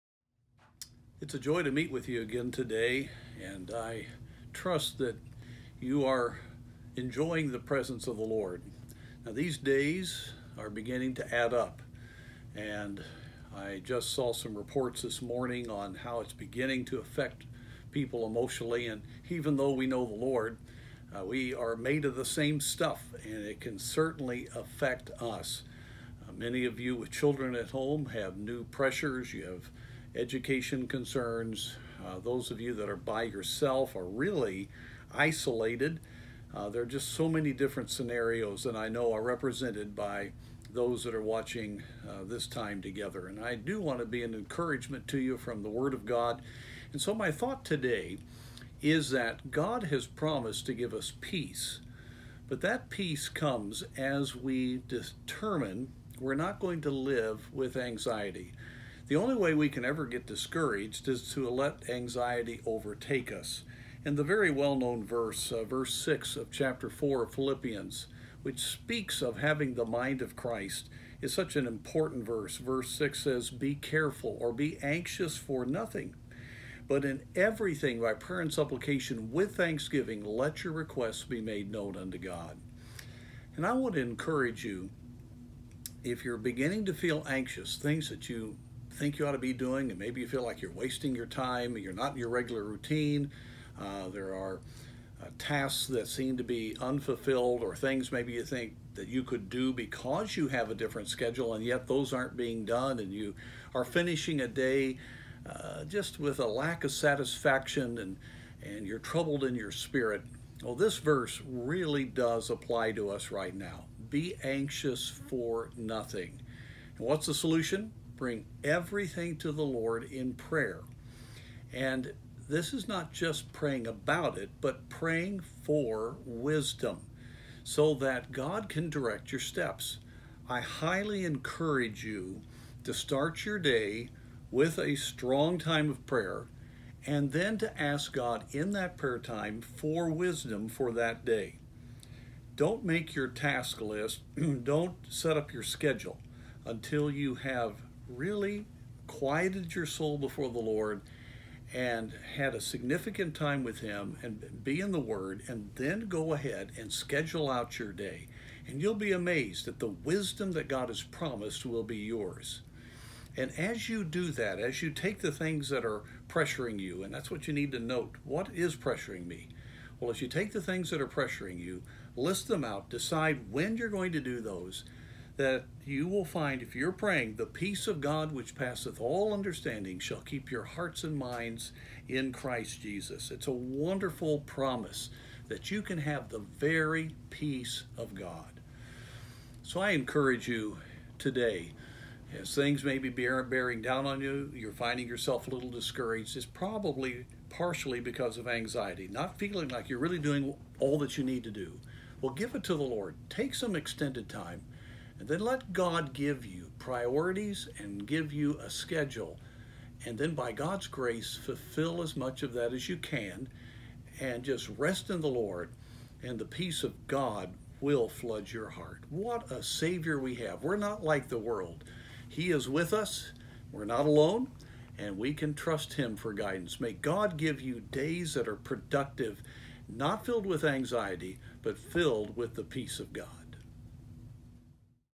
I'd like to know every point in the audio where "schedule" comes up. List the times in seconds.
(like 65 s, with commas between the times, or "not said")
101 s, 145 s, 156 s, 208 s.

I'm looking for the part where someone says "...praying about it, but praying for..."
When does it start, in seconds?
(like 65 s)
123 s.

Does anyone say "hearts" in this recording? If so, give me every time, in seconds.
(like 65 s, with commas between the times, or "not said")
180 s, 218 s.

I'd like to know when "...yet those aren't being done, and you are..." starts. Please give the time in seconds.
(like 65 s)
101 s.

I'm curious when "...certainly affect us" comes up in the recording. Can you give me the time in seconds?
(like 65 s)
23 s.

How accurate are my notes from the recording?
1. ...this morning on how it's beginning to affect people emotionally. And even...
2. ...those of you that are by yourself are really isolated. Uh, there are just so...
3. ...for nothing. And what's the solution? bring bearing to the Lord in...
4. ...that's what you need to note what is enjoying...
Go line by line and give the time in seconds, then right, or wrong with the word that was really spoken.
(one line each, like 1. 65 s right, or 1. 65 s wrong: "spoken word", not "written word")
1. 15 s right
2. 32 s right
3. 115 s wrong: "everything", not "bearing"
4. 167 s wrong: "pressuring", not "enjoying".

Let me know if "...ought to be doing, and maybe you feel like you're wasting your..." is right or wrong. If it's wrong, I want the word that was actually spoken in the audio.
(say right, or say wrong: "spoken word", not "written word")
right.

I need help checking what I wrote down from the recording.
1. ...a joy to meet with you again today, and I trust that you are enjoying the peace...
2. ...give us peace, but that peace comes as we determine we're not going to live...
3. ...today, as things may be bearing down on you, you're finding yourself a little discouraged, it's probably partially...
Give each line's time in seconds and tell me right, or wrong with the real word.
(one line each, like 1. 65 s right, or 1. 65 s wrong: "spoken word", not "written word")
1. 1 s wrong: "presence", not "peace"
2. 50 s right
3. 191 s right.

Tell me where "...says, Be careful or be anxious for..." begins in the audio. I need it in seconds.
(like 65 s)
73 s.